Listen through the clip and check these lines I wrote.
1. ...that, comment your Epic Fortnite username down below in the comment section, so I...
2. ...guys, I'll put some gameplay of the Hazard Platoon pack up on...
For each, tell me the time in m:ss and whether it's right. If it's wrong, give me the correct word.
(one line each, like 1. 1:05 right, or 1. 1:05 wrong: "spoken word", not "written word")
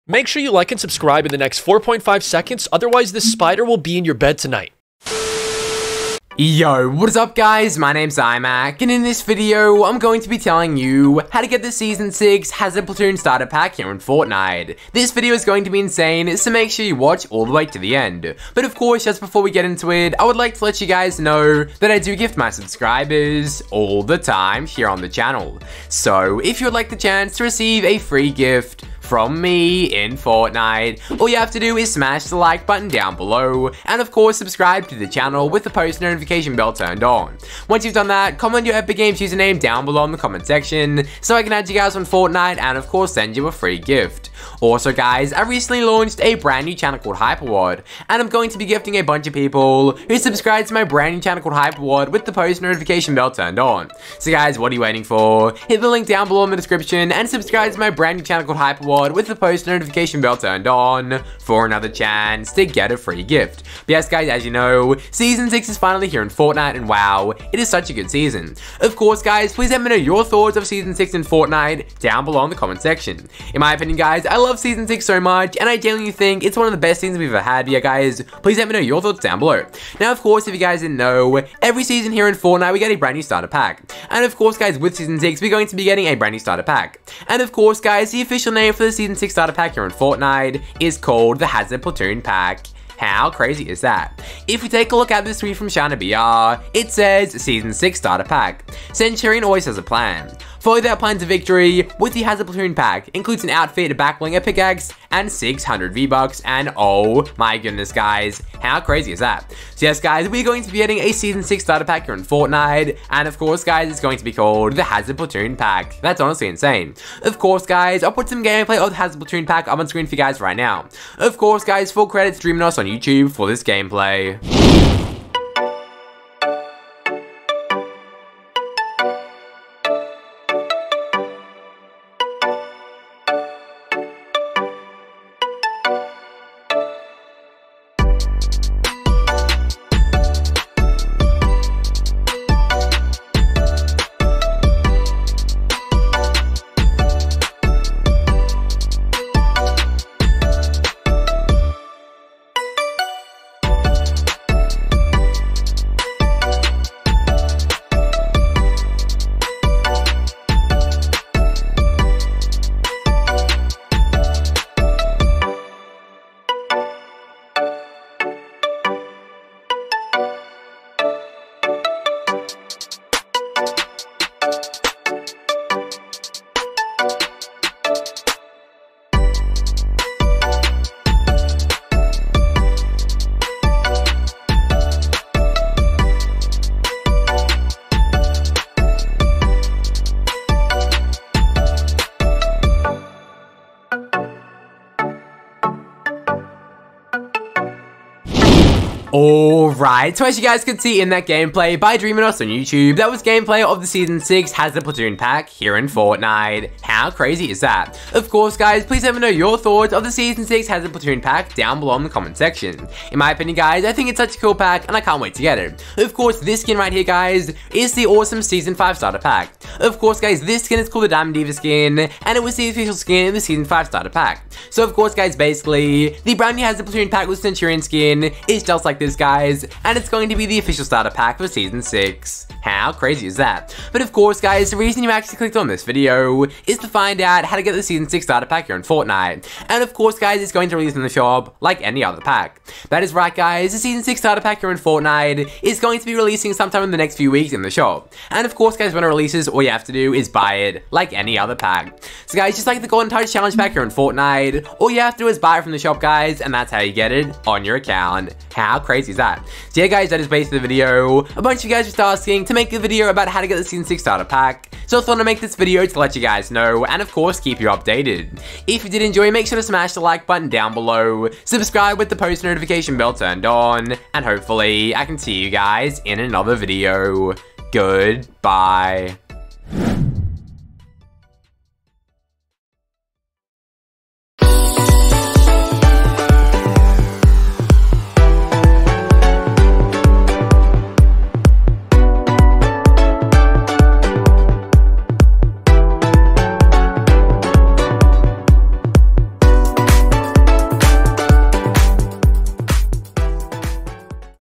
1. 0:38 wrong: "Games", not "Fortnite"
2. 1:57 right.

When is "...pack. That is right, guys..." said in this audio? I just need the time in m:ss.
4:02.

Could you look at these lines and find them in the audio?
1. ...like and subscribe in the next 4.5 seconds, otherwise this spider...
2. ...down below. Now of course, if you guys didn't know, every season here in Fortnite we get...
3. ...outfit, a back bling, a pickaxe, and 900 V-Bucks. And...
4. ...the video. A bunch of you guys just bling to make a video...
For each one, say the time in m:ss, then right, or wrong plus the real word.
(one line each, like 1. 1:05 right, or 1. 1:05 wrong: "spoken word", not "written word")
1. 0:00 right
2. 1:19 right
3. 1:43 wrong: "600", not "900"
4. 4:20 wrong: "asking", not "bling".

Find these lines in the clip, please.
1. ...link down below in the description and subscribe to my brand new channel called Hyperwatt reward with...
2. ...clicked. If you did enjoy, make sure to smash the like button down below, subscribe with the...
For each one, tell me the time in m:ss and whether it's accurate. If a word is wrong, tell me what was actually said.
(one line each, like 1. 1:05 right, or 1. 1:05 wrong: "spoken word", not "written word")
1. 0:55 right
2. 4:27 wrong: "updated", not "clicked".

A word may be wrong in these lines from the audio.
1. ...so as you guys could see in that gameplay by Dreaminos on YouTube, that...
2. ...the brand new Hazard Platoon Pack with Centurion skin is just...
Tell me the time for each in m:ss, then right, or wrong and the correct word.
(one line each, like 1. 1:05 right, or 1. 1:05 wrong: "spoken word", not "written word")
1. 3:20 right
2. 3:46 right.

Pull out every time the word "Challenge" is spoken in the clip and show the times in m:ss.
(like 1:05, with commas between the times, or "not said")
4:13.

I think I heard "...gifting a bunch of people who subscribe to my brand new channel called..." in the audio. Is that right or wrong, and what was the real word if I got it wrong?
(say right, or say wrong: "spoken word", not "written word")
right.